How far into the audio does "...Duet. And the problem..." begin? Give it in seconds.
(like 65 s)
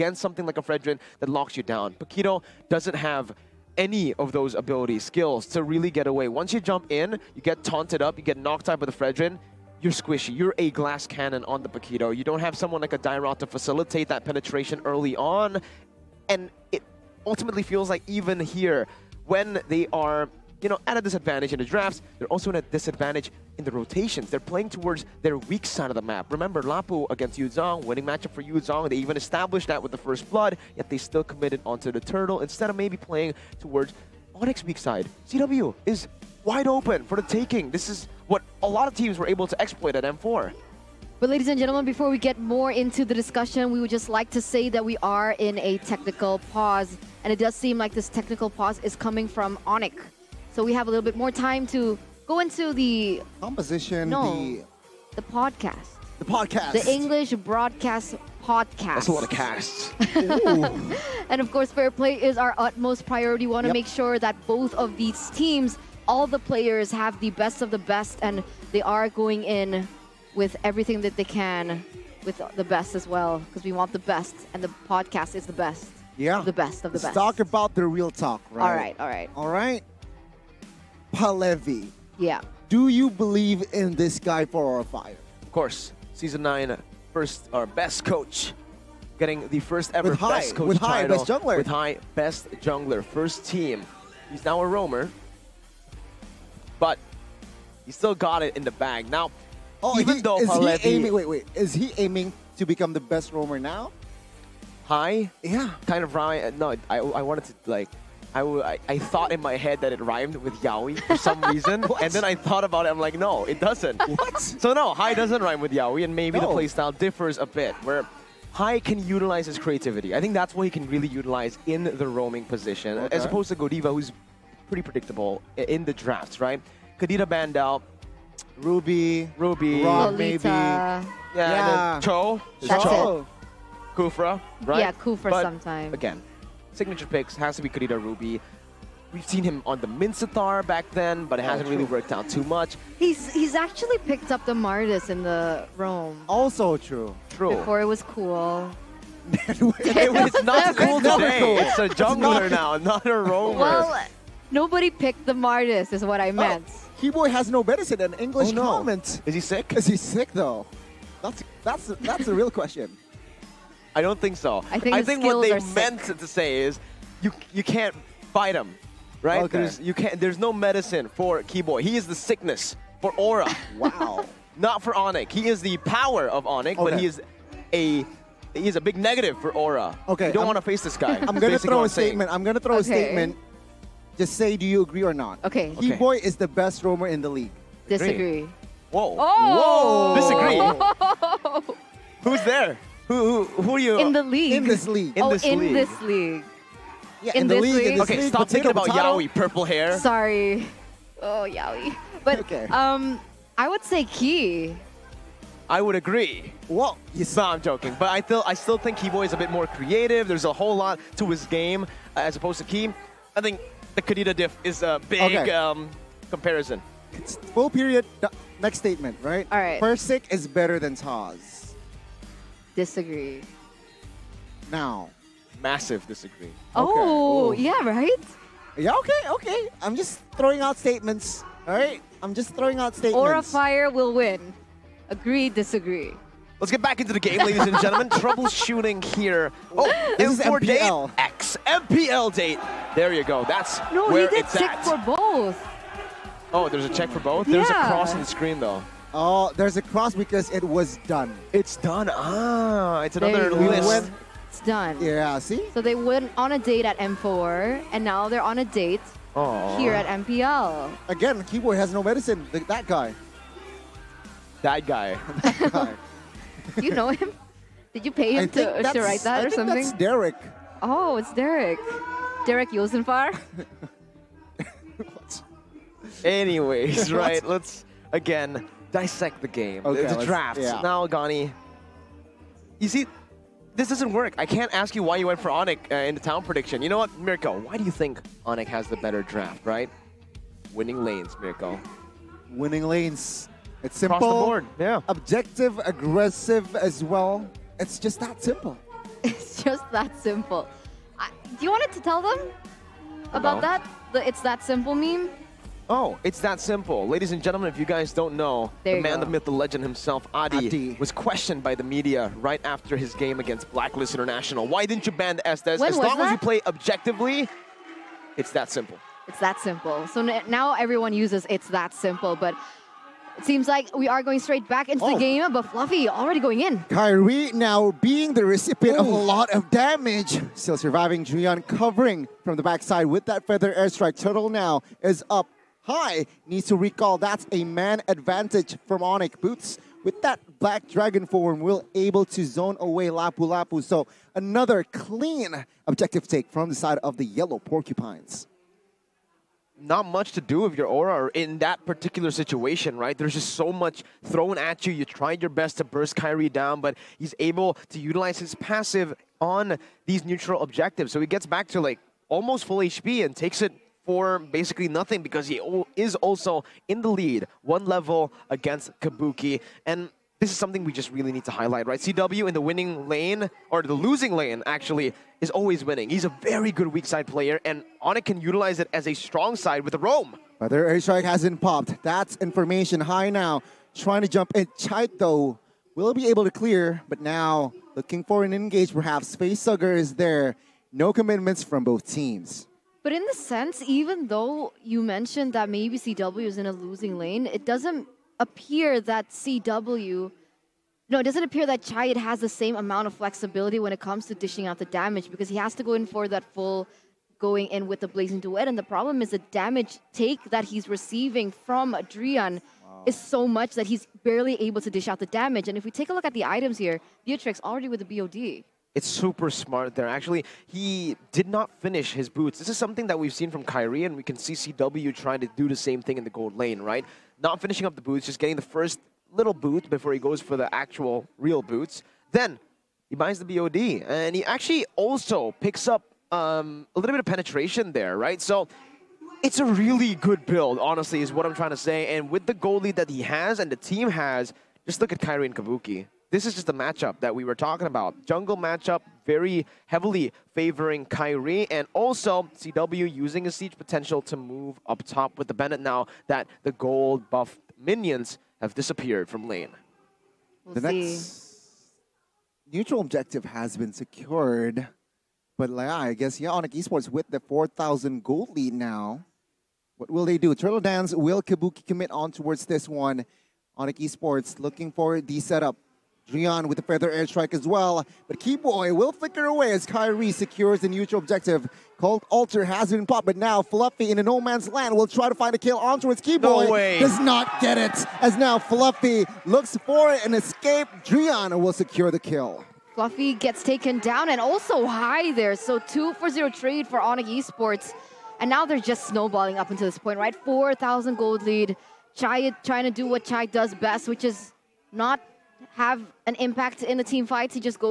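408 s.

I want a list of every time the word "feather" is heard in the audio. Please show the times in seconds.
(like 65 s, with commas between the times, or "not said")
333 s, 476 s.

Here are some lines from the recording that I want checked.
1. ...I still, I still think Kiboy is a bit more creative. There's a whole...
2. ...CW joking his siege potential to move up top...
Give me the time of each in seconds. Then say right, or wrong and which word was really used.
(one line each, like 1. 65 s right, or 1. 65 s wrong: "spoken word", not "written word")
1. 208 s right
2. 452 s wrong: "using", not "joking".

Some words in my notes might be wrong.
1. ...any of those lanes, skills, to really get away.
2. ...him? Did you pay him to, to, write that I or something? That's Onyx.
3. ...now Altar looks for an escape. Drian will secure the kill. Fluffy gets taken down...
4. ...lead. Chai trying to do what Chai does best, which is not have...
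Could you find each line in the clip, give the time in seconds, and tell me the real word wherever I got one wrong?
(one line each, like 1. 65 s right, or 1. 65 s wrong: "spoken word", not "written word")
1. 3 s wrong: "abilities", not "lanes"
2. 267 s wrong: "Derek", not "Onyx"
3. 488 s wrong: "Fluffy", not "Altar"
4. 501 s right.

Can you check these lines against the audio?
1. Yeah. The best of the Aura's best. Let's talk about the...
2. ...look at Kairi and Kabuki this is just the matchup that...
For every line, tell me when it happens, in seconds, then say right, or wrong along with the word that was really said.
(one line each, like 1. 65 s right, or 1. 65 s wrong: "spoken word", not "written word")
1. 76 s wrong: "Let", not "Aura"
2. 445 s right.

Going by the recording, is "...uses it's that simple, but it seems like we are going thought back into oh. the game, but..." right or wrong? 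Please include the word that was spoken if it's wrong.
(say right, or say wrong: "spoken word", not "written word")
wrong: "straight", not "thought".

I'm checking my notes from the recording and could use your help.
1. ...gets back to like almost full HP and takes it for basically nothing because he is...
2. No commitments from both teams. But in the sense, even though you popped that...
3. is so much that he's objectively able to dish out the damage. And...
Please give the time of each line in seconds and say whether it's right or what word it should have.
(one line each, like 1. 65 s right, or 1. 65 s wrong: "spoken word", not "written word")
1. 361 s right
2. 390 s wrong: "mentioned", not "popped"
3. 413 s wrong: "barely", not "objectively".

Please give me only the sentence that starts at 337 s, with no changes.
That's a man advantage from Onyx Boots.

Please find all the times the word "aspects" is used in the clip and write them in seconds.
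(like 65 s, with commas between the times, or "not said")
not said.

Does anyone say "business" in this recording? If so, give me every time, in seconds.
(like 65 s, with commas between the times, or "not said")
not said.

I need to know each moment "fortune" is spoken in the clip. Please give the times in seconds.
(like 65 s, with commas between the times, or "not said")
not said.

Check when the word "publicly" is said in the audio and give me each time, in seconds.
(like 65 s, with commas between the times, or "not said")
not said.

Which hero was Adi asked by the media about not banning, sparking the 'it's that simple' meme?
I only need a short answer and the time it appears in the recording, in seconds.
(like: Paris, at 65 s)
Estes, at 315 s.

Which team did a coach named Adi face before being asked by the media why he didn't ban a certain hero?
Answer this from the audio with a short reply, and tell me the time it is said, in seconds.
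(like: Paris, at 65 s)
Blacklist International, at 313 s.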